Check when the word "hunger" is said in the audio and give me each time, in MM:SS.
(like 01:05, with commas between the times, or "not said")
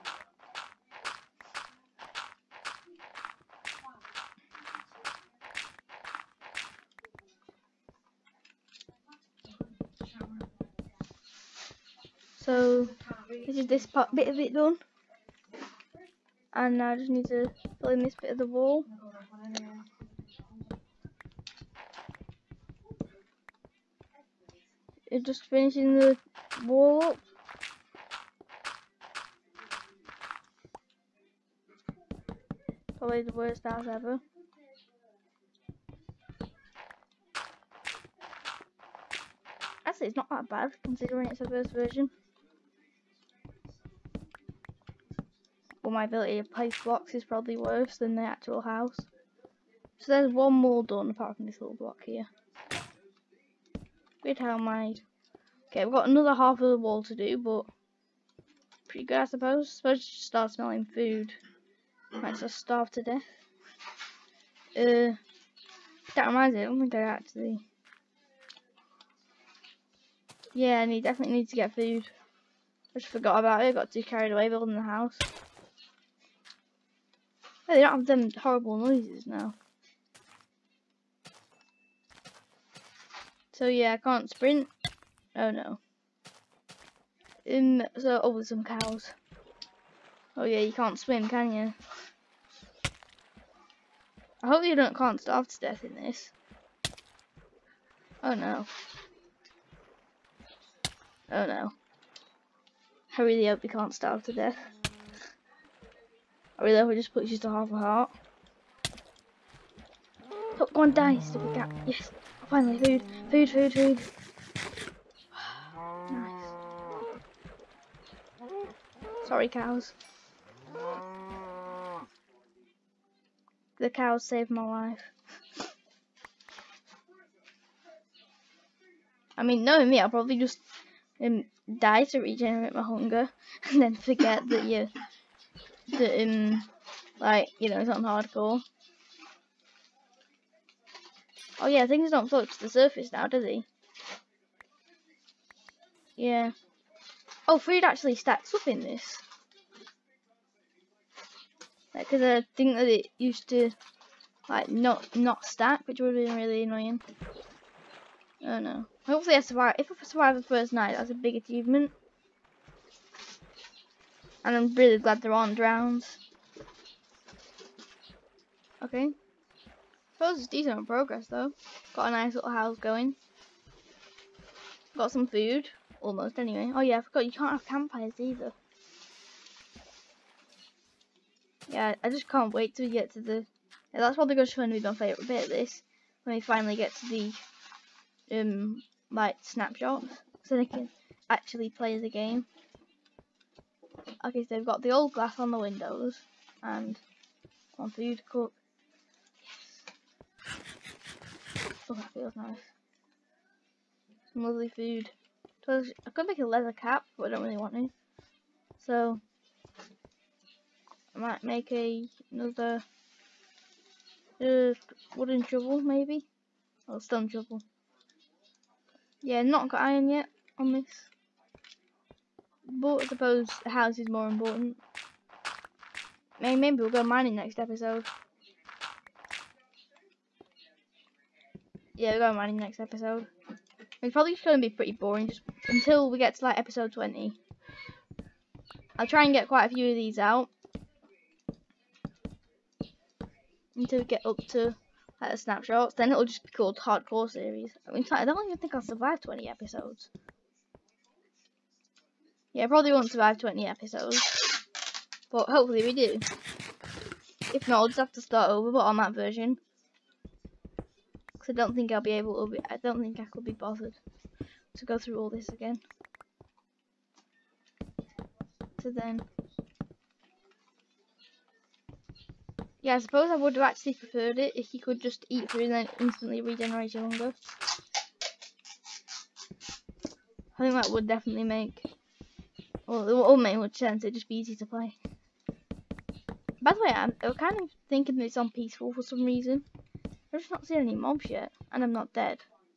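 02:12, 04:37.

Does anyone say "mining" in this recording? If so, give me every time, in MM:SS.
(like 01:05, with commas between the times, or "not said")
03:47, 03:52.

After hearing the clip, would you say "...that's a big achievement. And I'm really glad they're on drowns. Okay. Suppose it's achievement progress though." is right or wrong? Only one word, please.
wrong.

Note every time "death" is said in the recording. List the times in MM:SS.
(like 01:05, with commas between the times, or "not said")
01:03, 01:35, 01:44.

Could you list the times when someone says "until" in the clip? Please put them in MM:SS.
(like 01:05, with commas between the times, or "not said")
03:55, 04:03.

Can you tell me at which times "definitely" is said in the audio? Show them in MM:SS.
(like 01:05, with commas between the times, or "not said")
01:11, 04:41.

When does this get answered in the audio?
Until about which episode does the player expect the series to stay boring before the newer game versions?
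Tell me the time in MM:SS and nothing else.
03:56.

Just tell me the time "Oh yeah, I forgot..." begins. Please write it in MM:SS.
02:56.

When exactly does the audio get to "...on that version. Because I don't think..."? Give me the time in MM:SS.
04:18.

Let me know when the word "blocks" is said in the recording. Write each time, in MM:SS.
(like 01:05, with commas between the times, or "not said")
00:46, 00:51.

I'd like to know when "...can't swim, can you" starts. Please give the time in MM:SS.
01:30.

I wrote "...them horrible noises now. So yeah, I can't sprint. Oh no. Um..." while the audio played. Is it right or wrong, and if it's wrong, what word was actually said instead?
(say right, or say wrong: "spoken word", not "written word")
right.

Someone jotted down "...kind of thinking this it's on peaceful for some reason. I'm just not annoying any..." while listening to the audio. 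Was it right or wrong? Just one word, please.
wrong.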